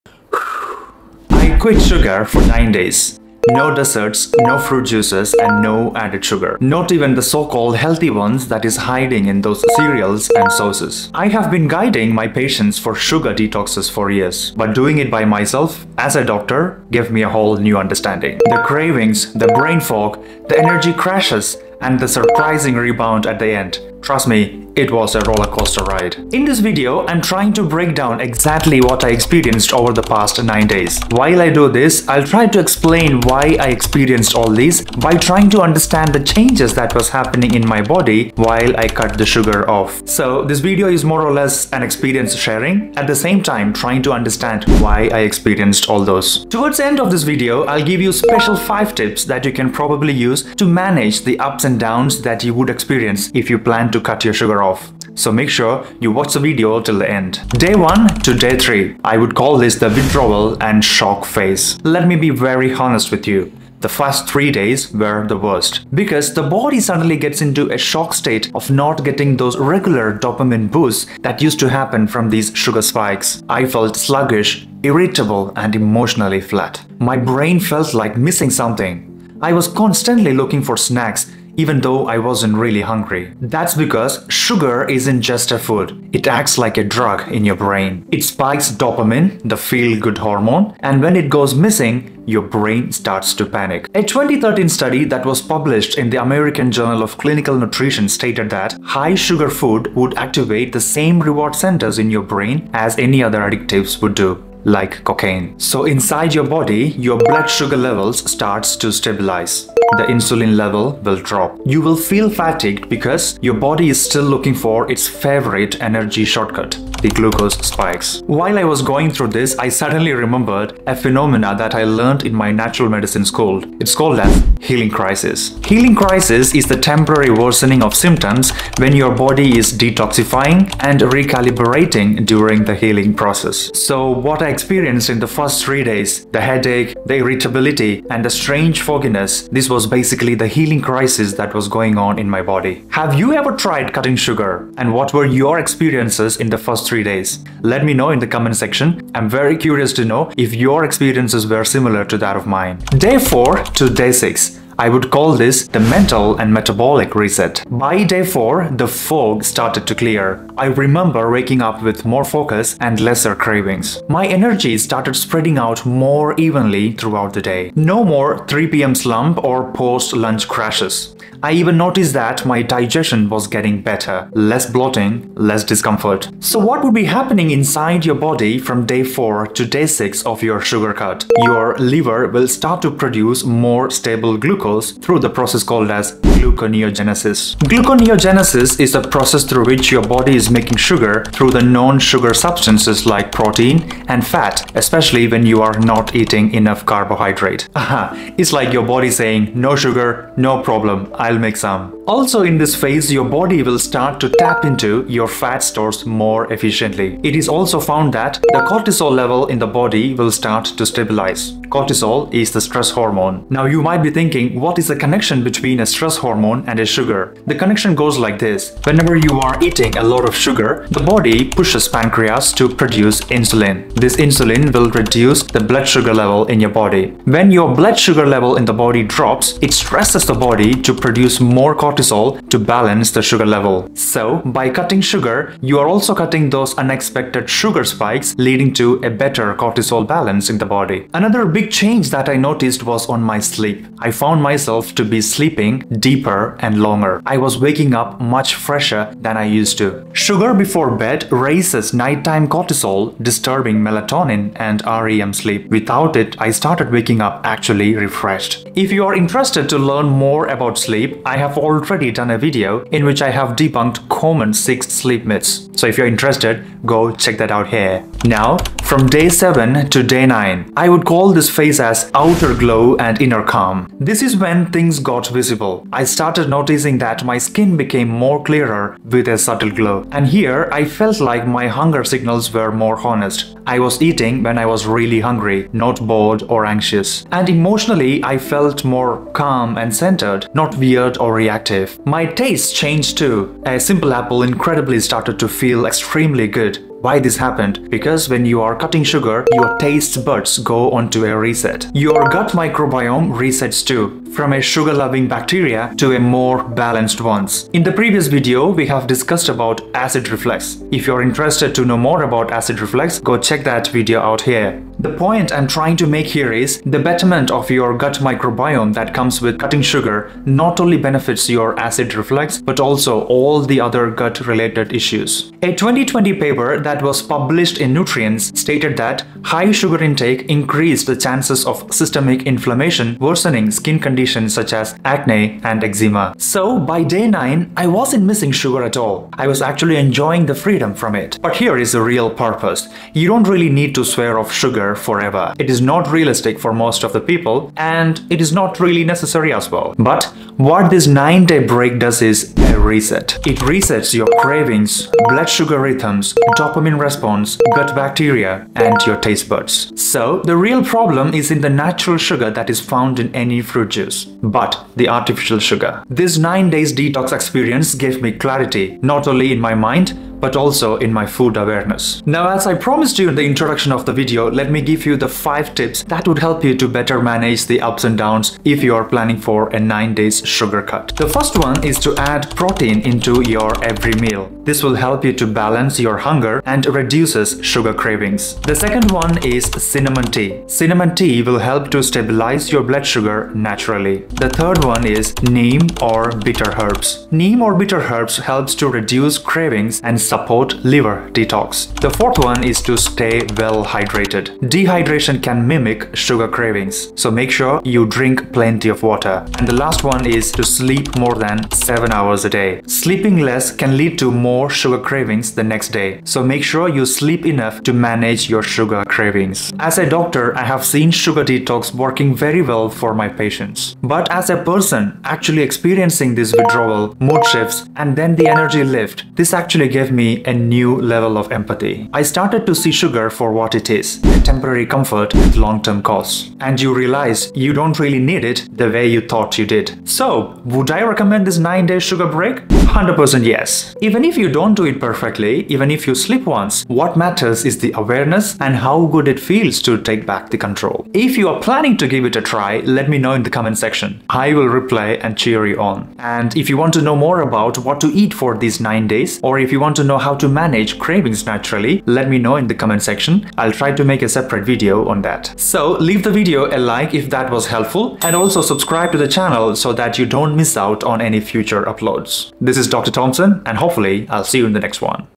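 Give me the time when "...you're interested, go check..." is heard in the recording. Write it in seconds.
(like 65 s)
265 s.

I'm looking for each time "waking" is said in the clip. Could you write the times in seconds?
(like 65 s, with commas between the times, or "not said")
161 s, 247 s, 256 s.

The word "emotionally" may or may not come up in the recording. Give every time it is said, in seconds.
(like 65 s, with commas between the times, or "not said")
75 s, 287 s.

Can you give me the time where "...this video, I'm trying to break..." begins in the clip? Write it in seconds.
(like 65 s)
26 s.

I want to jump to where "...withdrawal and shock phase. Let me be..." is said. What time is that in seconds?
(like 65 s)
59 s.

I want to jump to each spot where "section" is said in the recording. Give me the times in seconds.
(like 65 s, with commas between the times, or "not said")
148 s, 453 s, 463 s.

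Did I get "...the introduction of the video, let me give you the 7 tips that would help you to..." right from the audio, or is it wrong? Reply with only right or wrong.
wrong.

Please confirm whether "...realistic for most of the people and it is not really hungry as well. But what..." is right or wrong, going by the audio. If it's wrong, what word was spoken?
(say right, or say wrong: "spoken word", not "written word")
wrong: "necessary", not "hungry".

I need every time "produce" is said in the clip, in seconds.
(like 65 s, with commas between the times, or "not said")
182 s, 222 s, 230 s.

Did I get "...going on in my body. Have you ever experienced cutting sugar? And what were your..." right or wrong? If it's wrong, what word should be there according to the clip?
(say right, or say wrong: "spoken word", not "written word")
wrong: "tried", not "experienced".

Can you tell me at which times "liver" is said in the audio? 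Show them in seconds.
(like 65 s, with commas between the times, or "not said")
181 s, 400 s.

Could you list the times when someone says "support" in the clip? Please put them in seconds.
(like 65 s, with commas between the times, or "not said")
400 s.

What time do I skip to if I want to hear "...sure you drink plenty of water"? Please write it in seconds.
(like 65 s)
407 s.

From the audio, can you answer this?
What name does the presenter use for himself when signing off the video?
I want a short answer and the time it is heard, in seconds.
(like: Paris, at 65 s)
Dr. Tomson, at 472 s.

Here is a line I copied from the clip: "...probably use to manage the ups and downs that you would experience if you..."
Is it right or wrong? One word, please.
right.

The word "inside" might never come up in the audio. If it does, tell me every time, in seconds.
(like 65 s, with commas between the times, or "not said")
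105 s, 177 s.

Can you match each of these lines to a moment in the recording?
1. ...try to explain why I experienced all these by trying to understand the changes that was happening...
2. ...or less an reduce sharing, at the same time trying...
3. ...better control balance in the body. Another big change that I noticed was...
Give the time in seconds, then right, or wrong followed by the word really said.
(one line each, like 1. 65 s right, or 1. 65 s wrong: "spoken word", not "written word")
1. 32 s right
2. 41 s wrong: "experience", not "reduce"
3. 239 s wrong: "cortisol", not "control".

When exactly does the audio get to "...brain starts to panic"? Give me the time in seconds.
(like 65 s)
92 s.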